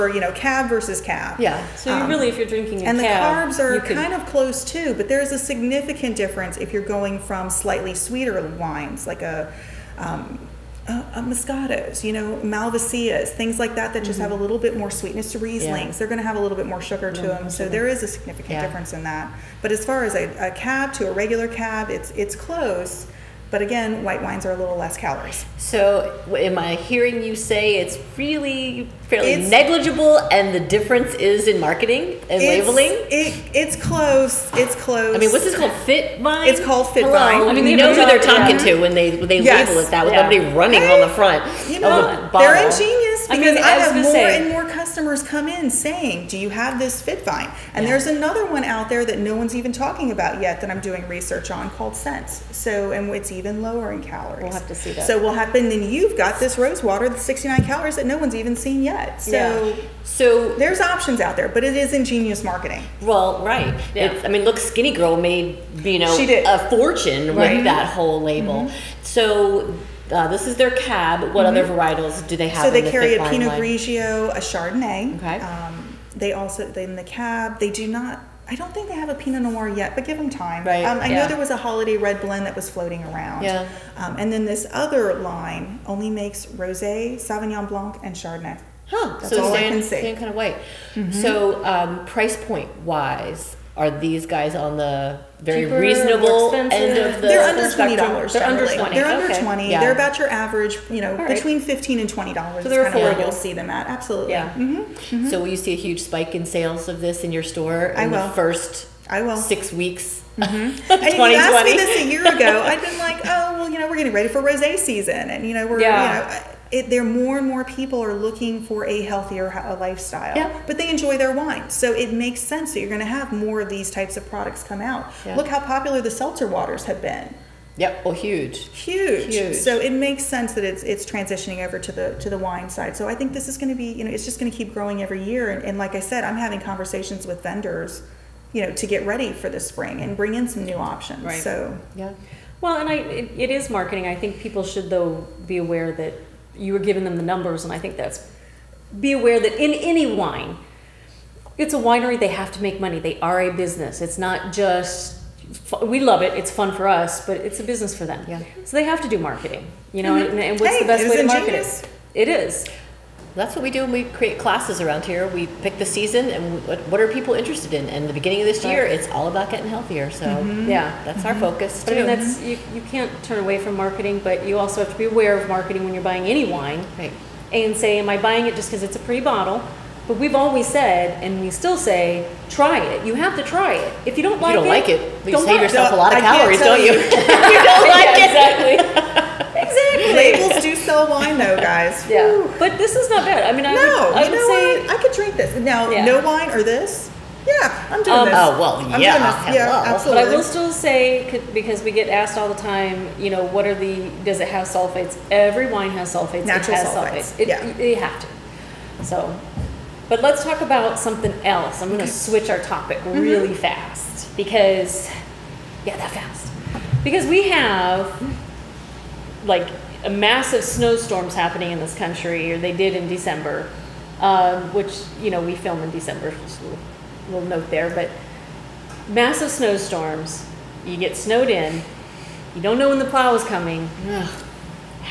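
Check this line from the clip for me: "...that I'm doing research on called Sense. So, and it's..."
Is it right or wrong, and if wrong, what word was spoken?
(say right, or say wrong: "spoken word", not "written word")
right.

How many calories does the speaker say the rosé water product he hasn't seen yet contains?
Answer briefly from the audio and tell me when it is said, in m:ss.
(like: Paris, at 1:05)
69, at 0:57.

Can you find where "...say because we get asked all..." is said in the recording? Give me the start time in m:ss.
3:20.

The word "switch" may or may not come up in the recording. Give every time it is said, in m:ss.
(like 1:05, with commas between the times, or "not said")
3:32.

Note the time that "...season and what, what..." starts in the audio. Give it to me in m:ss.
2:45.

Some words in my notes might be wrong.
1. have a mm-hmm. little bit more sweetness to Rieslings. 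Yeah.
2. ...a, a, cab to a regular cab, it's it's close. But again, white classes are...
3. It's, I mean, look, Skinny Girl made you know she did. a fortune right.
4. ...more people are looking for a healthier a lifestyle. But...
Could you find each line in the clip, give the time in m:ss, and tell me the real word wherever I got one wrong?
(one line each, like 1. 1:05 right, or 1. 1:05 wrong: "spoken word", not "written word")
1. 0:14 right
2. 0:20 wrong: "wines", not "classes"
3. 1:04 right
4. 1:57 right.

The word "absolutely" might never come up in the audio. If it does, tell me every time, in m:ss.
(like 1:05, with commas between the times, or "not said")
1:43, 3:19.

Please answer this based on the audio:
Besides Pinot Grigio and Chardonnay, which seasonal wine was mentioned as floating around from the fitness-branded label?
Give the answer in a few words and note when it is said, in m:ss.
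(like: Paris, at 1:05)
Holiday red blend, at 1:21.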